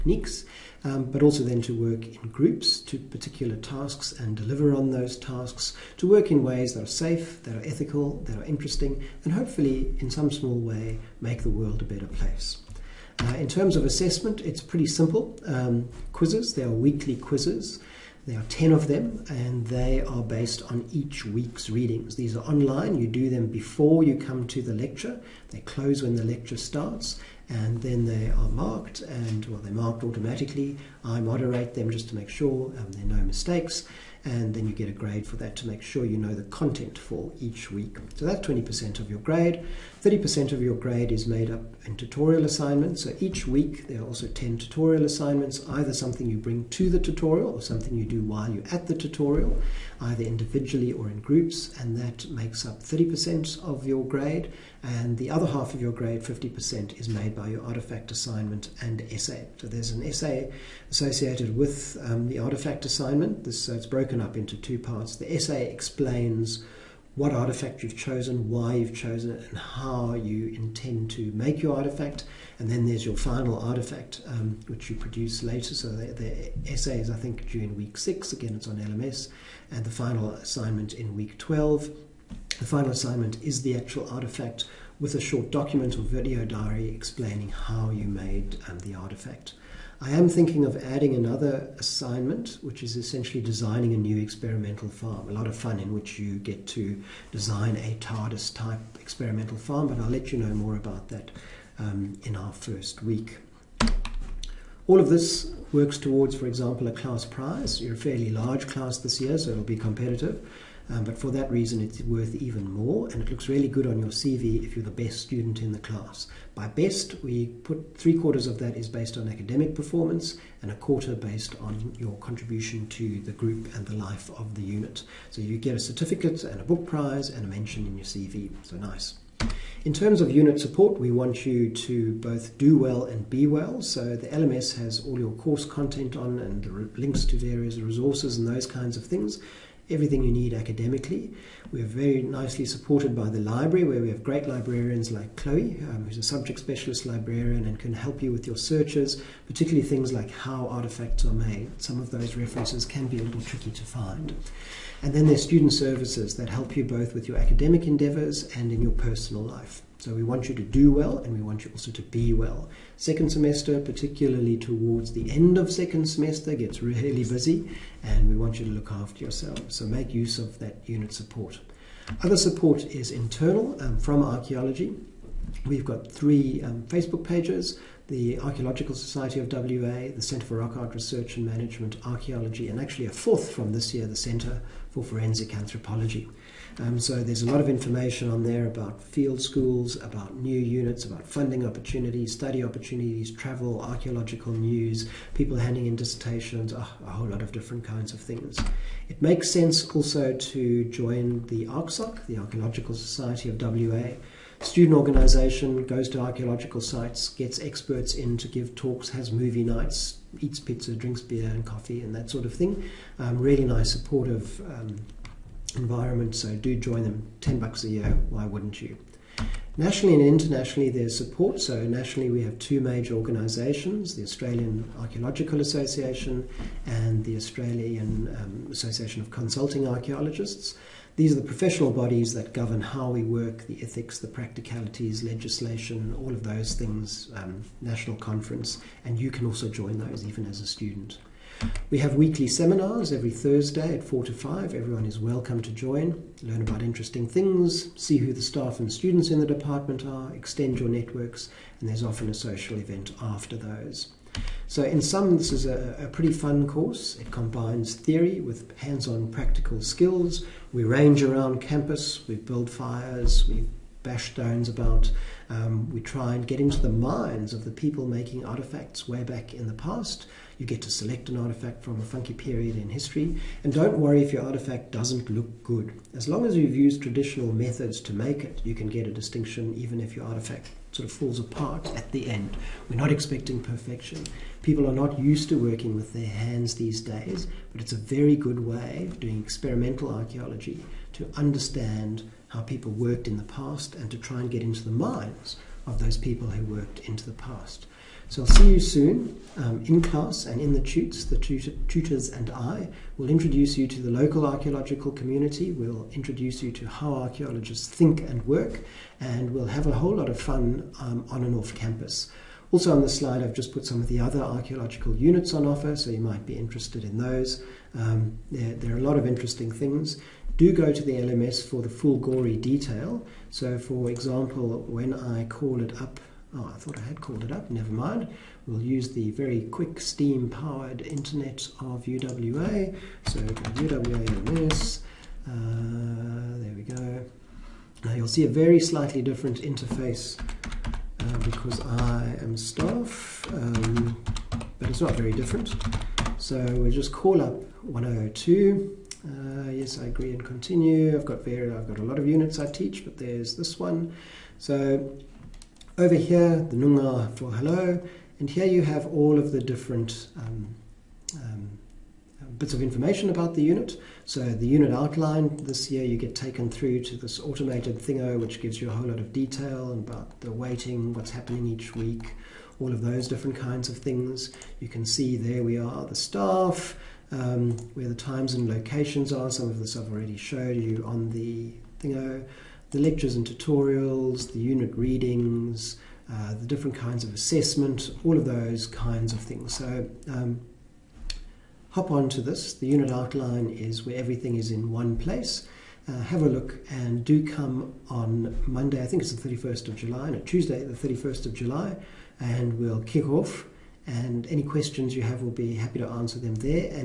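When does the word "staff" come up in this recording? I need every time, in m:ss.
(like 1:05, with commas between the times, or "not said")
4:08, 5:42, 6:16.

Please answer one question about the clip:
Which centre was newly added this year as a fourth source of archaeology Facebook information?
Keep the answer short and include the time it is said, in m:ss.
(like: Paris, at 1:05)
Centre for Forensic Anthropology, at 3:04.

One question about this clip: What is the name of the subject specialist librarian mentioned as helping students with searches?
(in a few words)
Chloe.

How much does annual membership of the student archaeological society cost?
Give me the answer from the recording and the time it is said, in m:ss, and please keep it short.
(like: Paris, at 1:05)
$10, at 3:37.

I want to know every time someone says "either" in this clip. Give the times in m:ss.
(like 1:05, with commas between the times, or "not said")
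0:45, 0:50.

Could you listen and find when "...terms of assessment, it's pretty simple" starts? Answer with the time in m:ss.
0:13.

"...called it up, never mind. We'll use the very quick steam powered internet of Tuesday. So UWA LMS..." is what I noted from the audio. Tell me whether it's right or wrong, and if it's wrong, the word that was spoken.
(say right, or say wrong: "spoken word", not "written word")
wrong: "UWA", not "Tuesday".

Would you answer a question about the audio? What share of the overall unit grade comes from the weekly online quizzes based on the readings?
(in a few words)
20%.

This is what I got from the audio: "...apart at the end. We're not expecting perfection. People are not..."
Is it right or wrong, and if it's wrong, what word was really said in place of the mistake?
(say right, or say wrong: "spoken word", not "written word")
right.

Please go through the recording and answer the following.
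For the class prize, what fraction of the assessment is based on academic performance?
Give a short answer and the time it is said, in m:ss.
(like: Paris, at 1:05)
three quarters, at 1:57.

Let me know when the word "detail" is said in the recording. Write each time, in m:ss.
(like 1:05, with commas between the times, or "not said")
5:22, 6:09.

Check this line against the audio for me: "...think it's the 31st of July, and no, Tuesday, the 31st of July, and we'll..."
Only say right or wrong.
right.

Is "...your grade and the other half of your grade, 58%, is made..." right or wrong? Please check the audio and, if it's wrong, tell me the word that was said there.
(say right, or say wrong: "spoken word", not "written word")
wrong: "50", not "58".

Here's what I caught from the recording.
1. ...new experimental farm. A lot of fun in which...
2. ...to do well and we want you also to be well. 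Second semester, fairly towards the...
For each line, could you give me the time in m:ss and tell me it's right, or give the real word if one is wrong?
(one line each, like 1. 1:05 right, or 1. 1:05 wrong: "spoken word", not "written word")
1. 1:33 right
2. 2:40 wrong: "particularly", not "fairly".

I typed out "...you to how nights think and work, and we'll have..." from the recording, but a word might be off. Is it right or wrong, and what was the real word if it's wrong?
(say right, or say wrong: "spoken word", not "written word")
wrong: "archaeologists", not "nights".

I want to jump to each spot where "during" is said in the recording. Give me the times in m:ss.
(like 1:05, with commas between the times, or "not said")
1:17.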